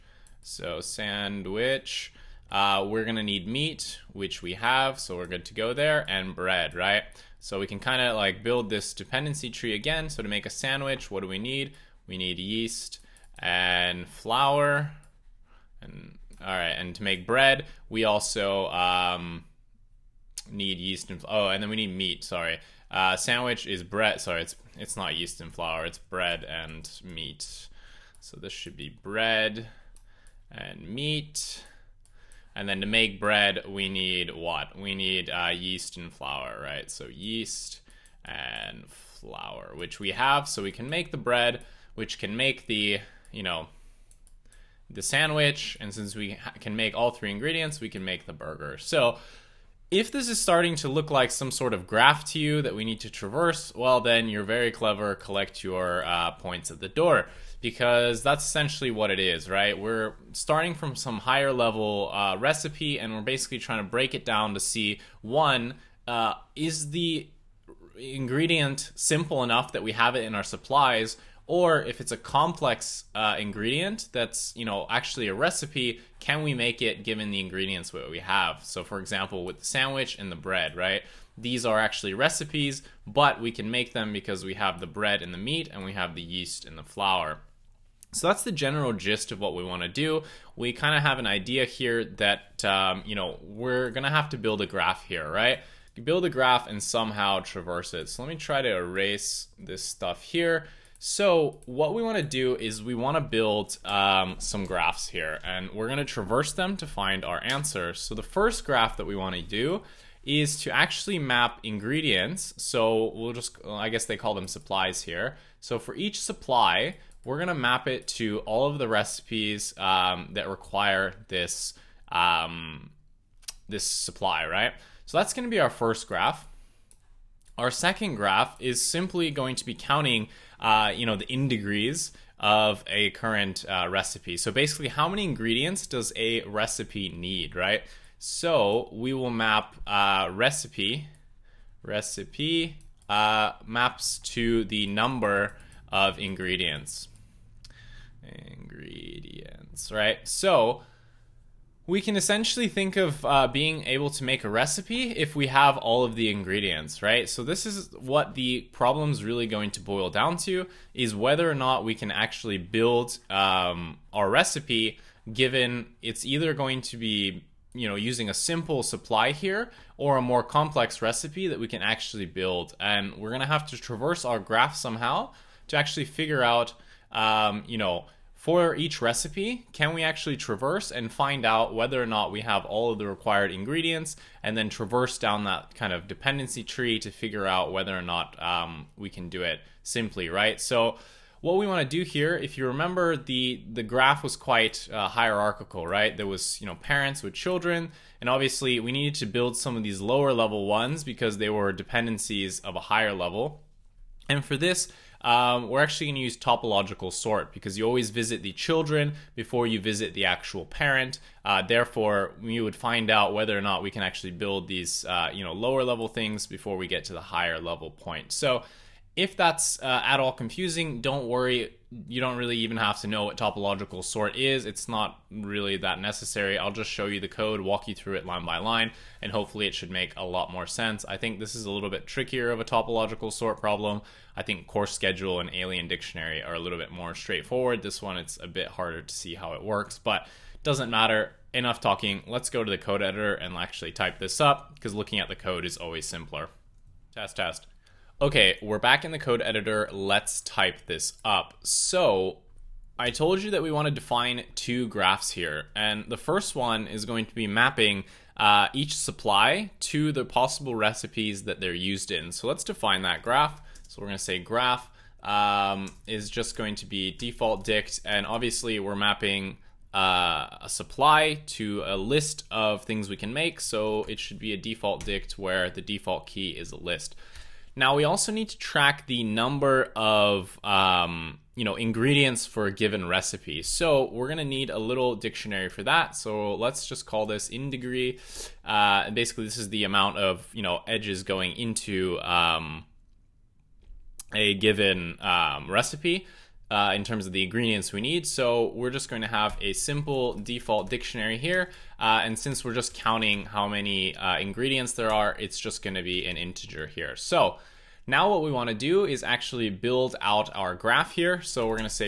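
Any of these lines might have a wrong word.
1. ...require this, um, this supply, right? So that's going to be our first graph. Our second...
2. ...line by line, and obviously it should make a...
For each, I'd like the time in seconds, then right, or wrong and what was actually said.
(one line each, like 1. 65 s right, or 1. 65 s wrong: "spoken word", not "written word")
1. 120 s right
2. 228 s wrong: "hopefully", not "obviously".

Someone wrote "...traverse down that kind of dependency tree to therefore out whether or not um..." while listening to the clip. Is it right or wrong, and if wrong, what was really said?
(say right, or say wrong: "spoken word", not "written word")
wrong: "figure", not "therefore".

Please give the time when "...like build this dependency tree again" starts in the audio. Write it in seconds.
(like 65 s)
8 s.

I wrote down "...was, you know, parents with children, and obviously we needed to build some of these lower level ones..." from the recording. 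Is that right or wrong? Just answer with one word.
right.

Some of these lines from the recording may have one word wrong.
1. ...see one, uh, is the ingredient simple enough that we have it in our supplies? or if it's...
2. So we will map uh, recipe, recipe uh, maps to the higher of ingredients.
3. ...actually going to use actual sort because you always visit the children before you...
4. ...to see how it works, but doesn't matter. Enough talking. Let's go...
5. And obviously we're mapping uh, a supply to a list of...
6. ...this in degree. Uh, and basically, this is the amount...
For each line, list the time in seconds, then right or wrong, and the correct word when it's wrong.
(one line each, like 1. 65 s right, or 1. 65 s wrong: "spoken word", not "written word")
1. 64 s right
2. 138 s wrong: "number", not "higher"
3. 205 s wrong: "topological", not "actual"
4. 239 s right
5. 268 s right
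6. 287 s right.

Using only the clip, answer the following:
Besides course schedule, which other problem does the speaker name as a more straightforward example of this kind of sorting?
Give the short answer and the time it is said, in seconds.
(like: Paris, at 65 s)
alien dictionary, at 235 s.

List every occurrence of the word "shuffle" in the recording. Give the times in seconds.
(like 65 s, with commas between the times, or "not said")
not said.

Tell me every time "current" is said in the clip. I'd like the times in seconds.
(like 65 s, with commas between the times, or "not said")
133 s.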